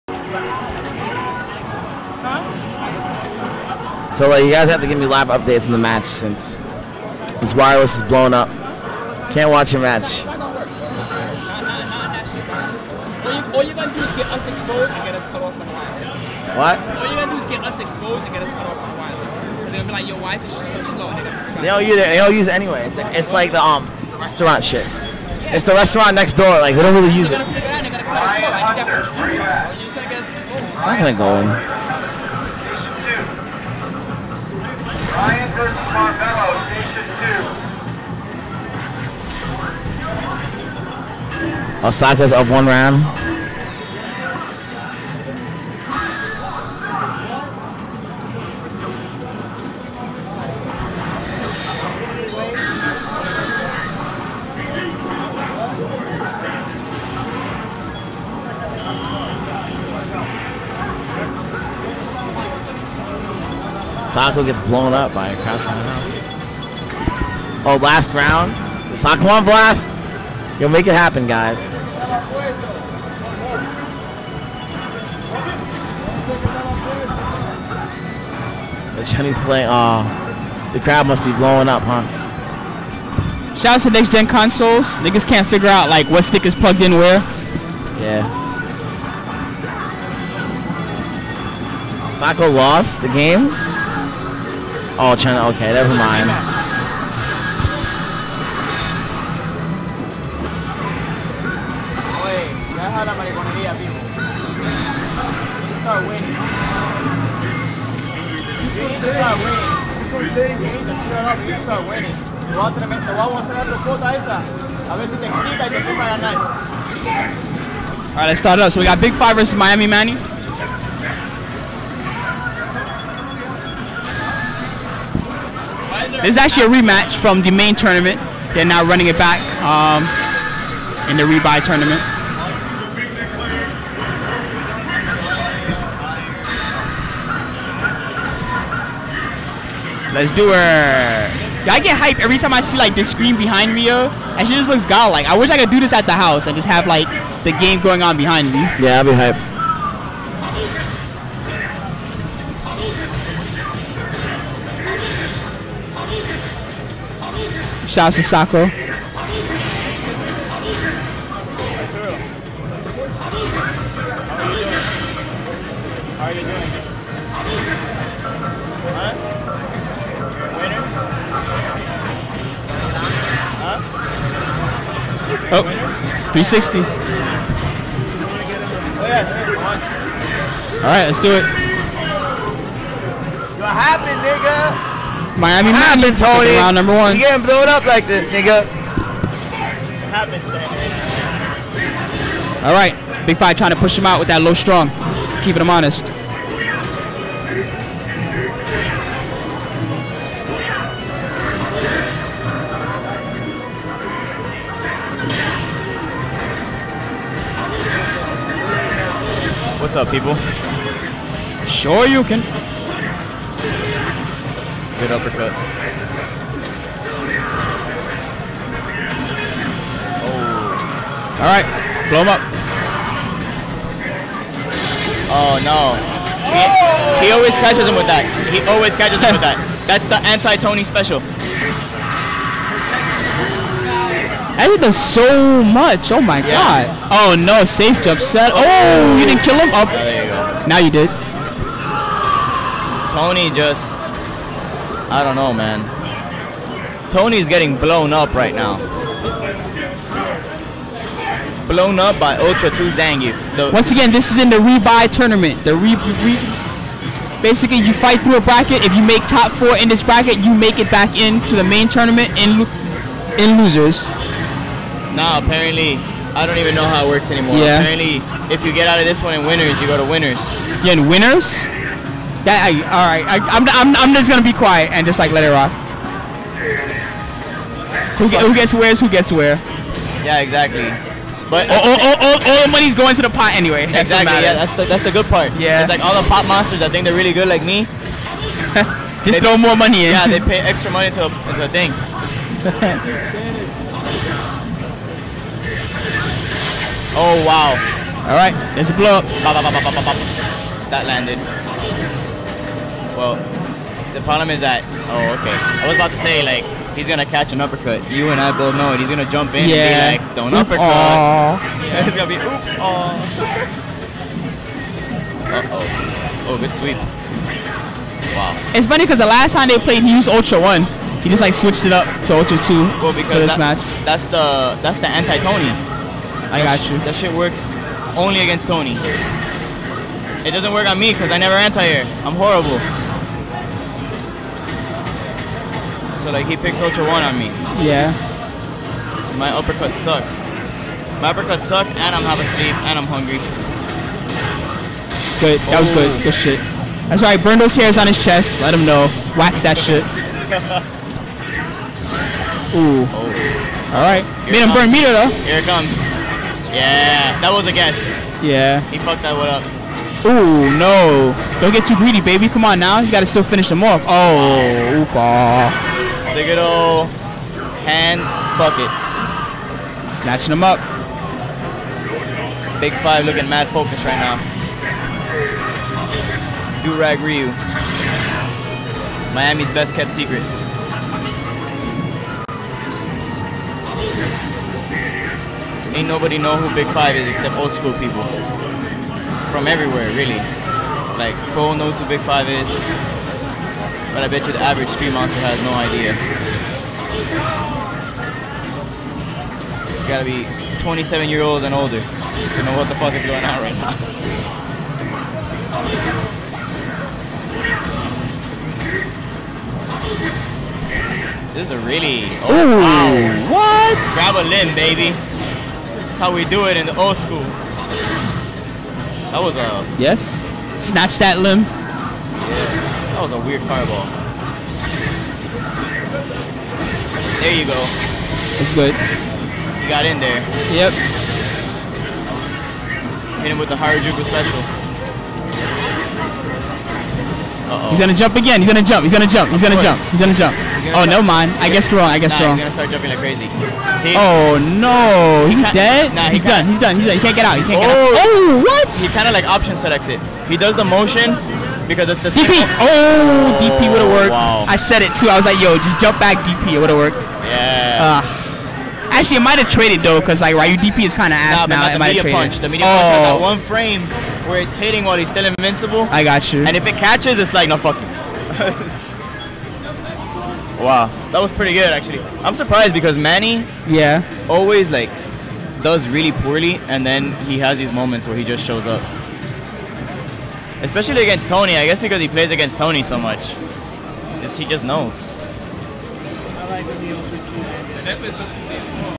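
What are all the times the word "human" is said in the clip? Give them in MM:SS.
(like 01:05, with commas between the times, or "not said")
not said.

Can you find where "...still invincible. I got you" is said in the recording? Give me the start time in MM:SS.
07:45.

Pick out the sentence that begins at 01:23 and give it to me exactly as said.
Shout out to next gen consoles.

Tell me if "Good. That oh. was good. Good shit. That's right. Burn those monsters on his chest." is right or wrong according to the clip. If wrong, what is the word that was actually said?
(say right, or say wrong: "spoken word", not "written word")
wrong: "hairs", not "monsters".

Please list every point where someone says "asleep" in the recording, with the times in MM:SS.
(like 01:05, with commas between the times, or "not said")
05:42.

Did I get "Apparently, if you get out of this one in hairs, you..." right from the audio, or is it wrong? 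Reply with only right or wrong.
wrong.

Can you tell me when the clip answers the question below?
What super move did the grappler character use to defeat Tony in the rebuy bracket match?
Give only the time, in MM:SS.
04:12.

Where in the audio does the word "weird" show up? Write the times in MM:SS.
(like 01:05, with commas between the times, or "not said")
07:03.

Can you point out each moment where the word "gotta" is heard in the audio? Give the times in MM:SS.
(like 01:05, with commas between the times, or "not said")
00:17, 06:40.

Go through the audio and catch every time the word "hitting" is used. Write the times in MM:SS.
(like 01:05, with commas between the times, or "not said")
07:44.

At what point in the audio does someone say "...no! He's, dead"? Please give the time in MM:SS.
07:24.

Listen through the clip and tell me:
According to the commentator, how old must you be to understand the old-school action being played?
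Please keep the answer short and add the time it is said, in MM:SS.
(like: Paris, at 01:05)
27, at 06:40.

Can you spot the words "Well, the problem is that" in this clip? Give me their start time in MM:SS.
05:03.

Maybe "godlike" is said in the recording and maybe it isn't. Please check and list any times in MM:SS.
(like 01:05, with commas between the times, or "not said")
02:24.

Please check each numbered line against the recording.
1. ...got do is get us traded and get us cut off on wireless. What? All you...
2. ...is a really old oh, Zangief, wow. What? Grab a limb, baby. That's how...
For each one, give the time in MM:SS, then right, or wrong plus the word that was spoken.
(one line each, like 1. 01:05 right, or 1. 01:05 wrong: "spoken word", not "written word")
1. 00:13 wrong: "exposed", not "traded"
2. 06:51 wrong: "Ooh", not "Zangief".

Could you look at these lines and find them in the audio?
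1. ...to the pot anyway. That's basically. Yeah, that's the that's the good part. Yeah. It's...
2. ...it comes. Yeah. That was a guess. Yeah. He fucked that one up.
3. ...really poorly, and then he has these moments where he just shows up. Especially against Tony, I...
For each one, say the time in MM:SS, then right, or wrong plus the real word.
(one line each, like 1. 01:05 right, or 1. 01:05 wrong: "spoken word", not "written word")
1. 04:43 wrong: "exactly", not "basically"
2. 05:55 right
3. 07:56 right.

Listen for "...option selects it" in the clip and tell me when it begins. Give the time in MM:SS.
07:29.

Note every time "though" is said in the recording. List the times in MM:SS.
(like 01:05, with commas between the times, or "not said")
05:55, 07:40.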